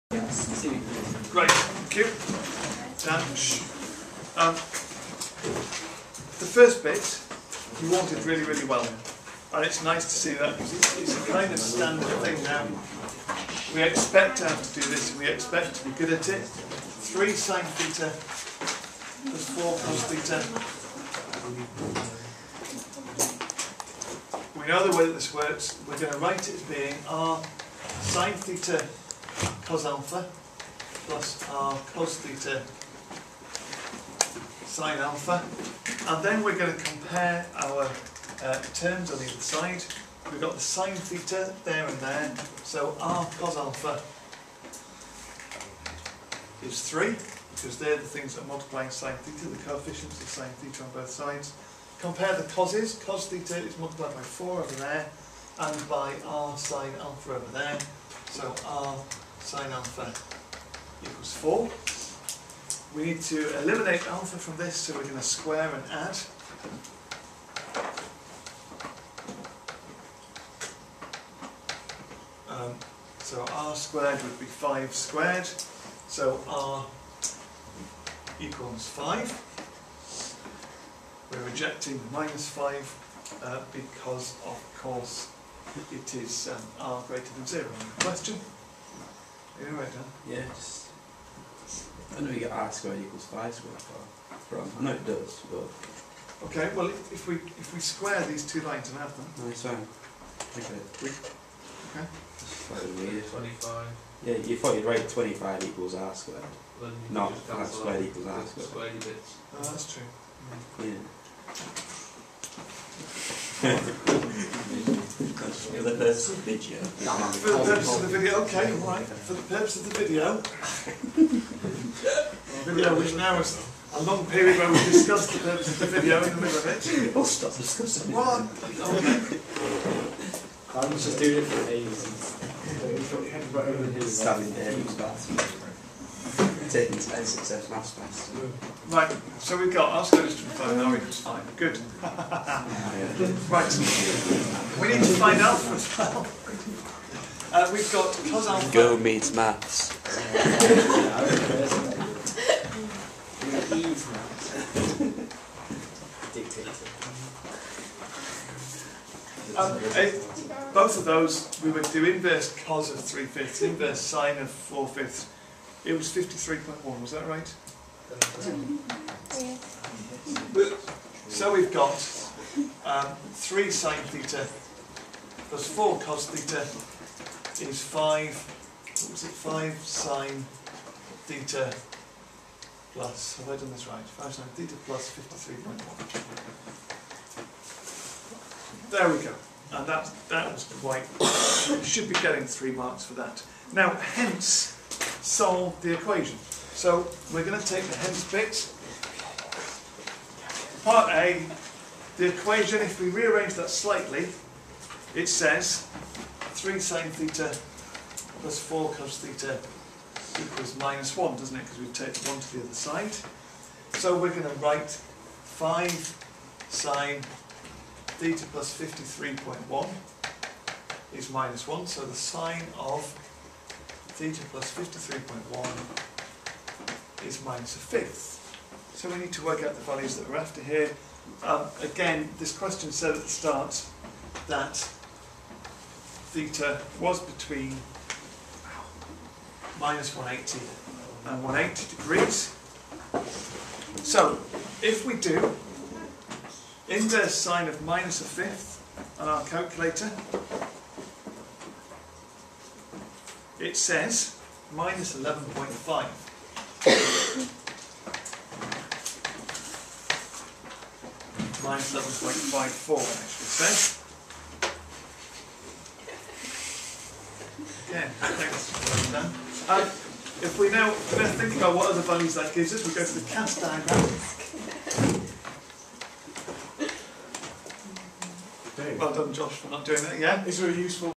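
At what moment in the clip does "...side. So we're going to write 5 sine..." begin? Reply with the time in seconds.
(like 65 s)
212 s.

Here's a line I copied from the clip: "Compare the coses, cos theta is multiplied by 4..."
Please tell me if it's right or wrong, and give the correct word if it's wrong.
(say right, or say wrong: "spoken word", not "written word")
right.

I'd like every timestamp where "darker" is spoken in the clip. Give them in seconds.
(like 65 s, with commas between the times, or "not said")
not said.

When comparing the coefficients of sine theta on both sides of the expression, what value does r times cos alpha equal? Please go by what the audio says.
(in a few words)
3.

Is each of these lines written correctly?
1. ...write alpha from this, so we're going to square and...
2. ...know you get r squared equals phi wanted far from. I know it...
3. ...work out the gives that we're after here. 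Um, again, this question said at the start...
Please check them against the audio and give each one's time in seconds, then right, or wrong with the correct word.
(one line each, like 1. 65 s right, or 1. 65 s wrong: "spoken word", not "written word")
1. 63 s wrong: "eliminate", not "write"
2. 92 s wrong: "squared", not "wanted"
3. 229 s wrong: "values", not "gives".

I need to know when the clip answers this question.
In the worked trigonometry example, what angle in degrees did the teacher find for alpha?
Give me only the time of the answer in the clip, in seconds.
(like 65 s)
166 s.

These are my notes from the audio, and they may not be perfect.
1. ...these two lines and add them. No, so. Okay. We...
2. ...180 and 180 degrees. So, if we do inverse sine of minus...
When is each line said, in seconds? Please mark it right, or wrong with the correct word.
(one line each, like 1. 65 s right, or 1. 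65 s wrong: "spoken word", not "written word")
1. 98 s right
2. 240 s right.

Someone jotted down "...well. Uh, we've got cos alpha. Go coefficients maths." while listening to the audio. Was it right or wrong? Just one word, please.
wrong.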